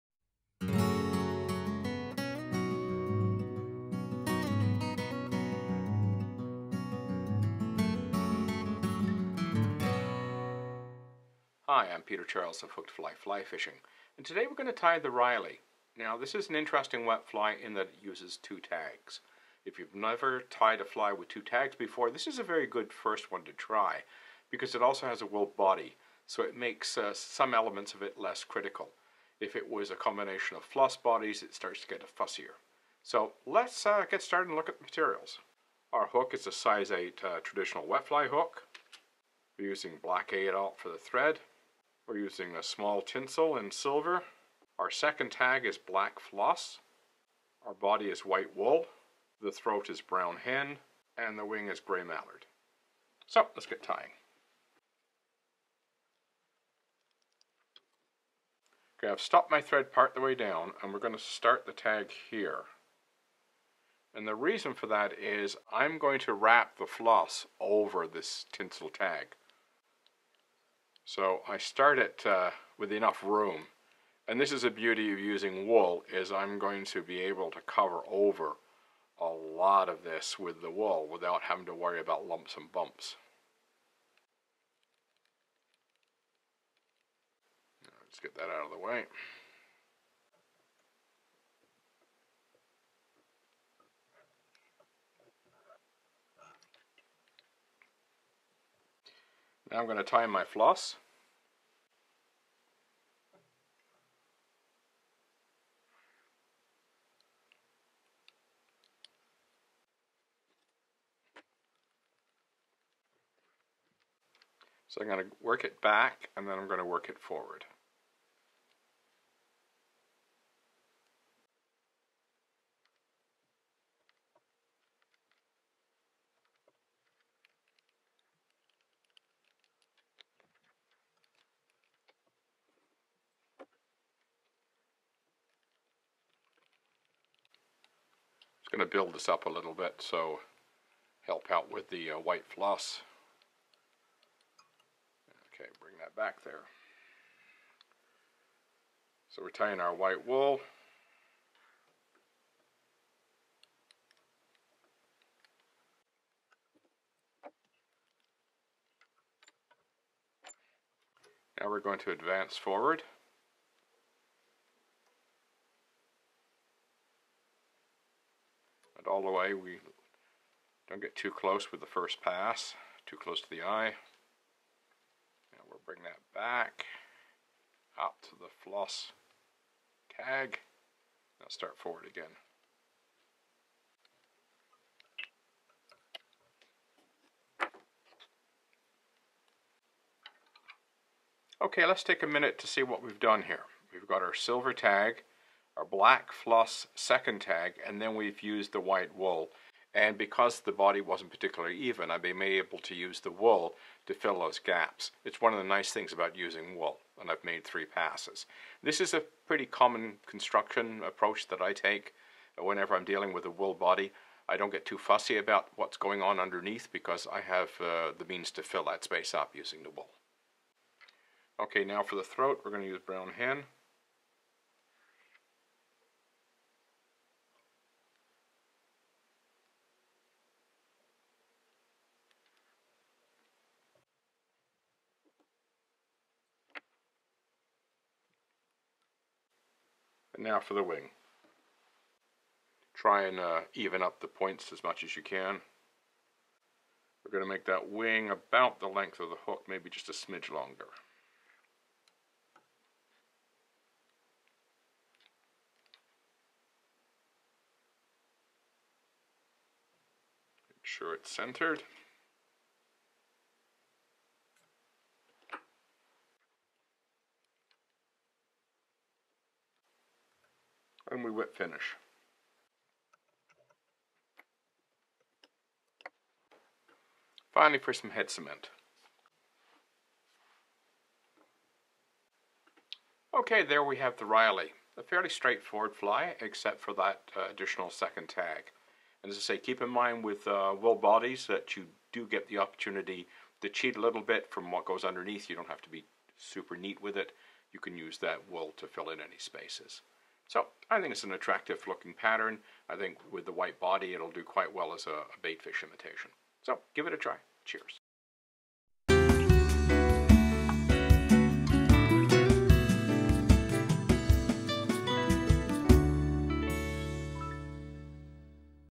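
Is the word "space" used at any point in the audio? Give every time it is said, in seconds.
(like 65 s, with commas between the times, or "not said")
219 s, 299 s.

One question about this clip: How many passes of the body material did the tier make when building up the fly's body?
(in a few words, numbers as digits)
3.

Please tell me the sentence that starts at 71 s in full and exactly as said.
So I start it uh, with enough room.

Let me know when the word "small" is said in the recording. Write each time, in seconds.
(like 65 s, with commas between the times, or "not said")
42 s.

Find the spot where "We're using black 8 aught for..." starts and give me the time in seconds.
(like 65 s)
39 s.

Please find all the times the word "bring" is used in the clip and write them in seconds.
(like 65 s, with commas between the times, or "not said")
145 s, 175 s.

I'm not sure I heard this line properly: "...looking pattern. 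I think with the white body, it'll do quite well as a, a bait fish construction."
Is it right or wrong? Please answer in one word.
wrong.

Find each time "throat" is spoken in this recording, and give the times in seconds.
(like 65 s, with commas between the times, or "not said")
49 s, 222 s.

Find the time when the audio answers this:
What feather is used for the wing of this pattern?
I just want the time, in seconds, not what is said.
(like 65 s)
51 s.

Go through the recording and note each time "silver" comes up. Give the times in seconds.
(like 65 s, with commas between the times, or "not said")
43 s, 194 s.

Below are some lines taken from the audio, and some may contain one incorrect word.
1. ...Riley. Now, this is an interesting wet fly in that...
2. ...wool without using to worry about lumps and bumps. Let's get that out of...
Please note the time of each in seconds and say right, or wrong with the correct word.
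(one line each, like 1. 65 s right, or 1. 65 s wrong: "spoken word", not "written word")
1. 15 s right
2. 80 s wrong: "having", not "using".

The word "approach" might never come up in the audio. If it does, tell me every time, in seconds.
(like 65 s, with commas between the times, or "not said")
211 s.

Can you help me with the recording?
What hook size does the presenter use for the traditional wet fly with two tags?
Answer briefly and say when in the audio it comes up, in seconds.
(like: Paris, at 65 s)
8, at 36 s.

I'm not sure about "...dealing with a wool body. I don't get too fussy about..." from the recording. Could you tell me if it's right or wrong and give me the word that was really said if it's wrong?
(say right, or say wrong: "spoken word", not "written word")
right.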